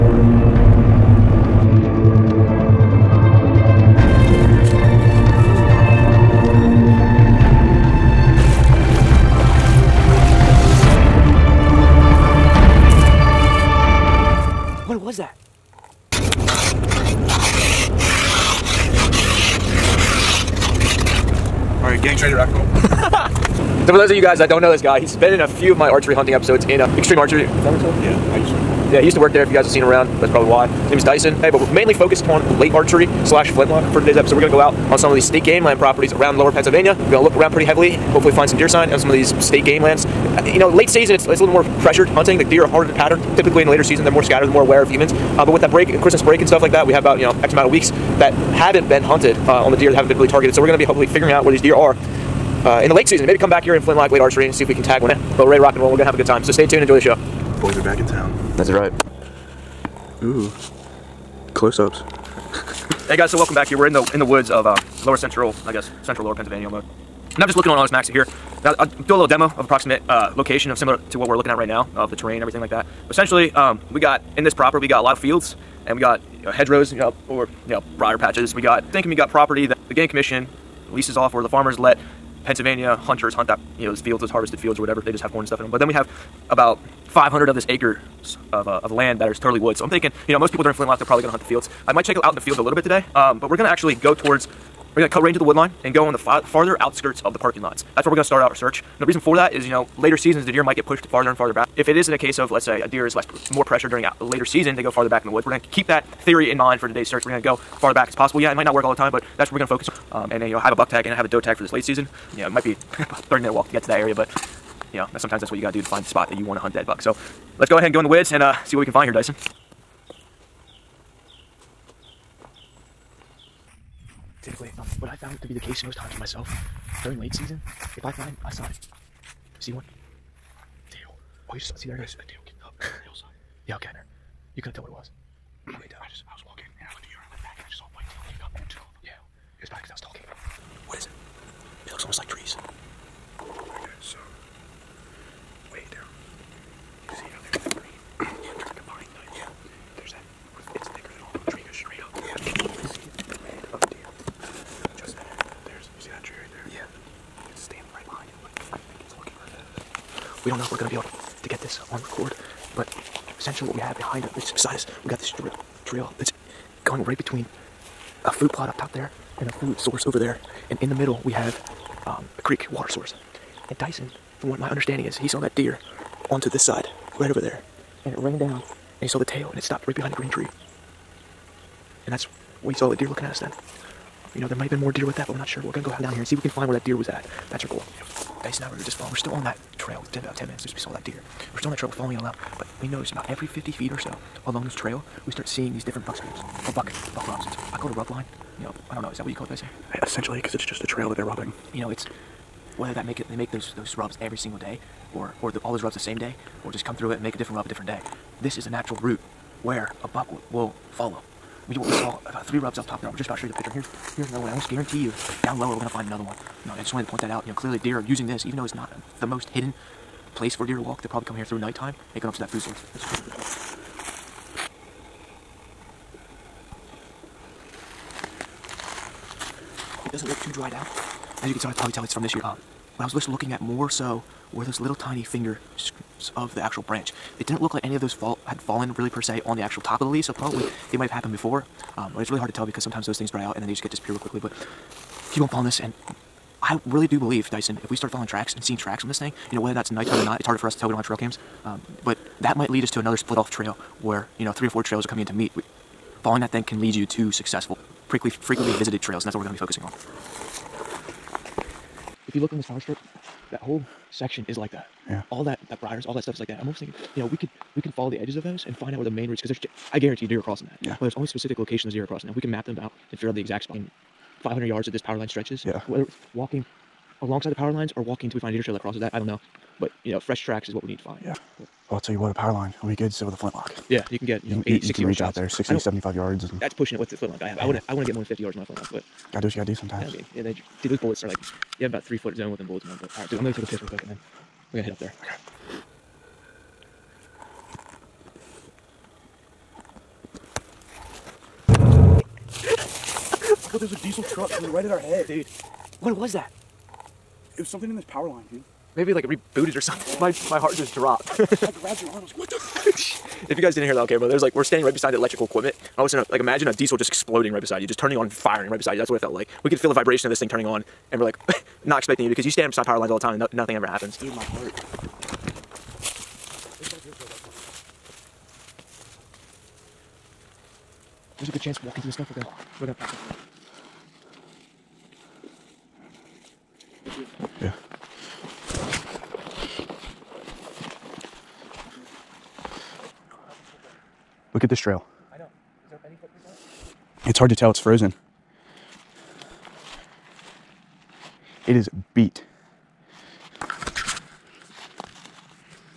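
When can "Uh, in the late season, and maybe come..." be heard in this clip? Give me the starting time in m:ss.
0:52.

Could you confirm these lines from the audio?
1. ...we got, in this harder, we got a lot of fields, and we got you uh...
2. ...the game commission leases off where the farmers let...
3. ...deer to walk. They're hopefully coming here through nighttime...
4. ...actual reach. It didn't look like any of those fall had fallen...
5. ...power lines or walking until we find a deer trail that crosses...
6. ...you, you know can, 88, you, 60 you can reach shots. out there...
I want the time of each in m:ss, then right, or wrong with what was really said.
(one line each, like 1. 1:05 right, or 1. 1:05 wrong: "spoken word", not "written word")
1. 1:13 wrong: "proper", not "harder"
2. 1:19 right
3. 3:40 wrong: "probably", not "hopefully"
4. 3:56 wrong: "branch", not "reach"
5. 4:37 right
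6. 4:44 wrong: "80", not "88".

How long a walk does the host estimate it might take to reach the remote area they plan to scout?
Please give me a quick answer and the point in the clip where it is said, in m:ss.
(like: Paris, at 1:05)
30 minutes, at 1:52.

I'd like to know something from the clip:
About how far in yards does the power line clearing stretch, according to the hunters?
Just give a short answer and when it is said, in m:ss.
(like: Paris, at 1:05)
500 yards, at 4:34.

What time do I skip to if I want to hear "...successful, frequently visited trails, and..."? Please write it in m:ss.
4:17.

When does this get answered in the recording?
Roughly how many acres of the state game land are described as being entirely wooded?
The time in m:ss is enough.
1:26.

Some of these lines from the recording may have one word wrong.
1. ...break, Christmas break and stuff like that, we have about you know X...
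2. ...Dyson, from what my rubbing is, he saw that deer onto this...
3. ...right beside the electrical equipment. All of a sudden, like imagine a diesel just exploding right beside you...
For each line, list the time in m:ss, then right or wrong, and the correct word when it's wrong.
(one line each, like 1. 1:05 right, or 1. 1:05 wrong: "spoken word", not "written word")
1. 0:45 right
2. 2:53 wrong: "understanding", not "rubbing"
3. 5:14 right.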